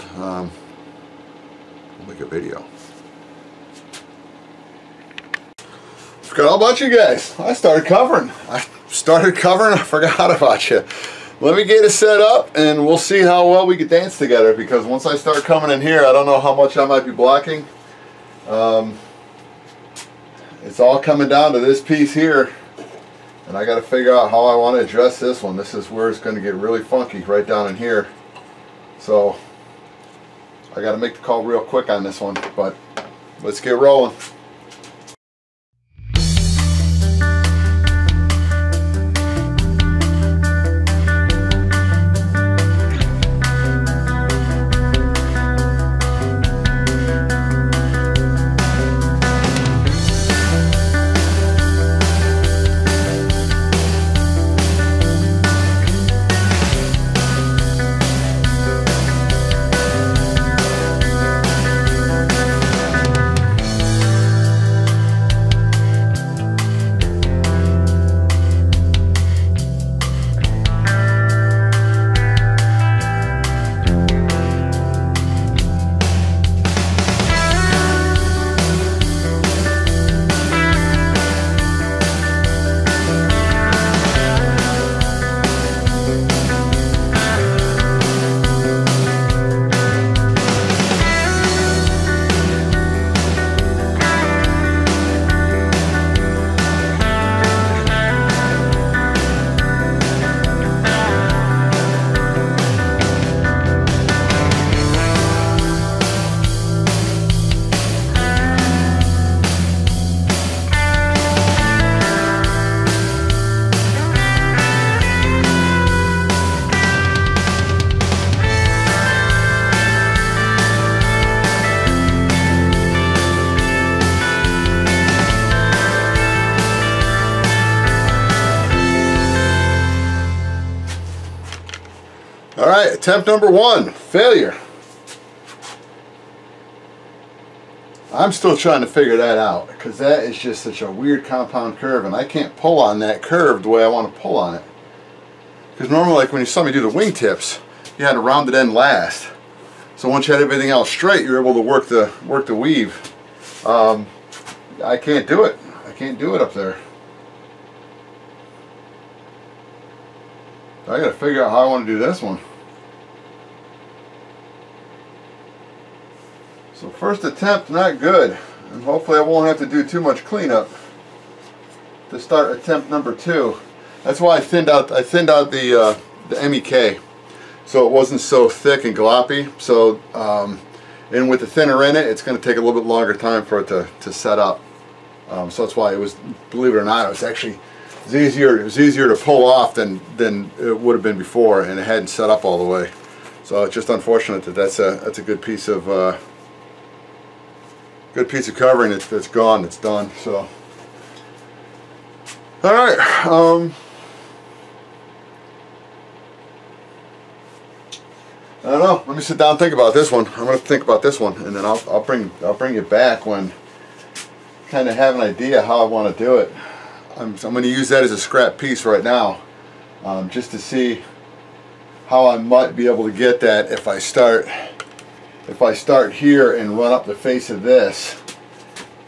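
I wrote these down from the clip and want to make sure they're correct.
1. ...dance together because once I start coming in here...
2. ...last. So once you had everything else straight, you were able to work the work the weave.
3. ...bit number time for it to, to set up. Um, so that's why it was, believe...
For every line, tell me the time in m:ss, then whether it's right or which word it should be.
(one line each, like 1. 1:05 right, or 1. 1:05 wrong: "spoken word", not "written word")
1. 0:13 right
2. 2:28 right
3. 3:02 wrong: "longer", not "number".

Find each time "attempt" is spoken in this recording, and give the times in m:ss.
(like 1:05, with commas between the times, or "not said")
2:13, 2:47, 2:52.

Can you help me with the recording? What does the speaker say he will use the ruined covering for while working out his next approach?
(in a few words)
Scrap piece.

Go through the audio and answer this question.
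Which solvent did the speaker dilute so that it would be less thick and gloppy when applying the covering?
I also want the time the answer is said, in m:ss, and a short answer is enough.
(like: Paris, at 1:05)
MEK, at 2:56.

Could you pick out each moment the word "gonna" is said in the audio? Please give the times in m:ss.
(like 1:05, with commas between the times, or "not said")
3:30, 3:37.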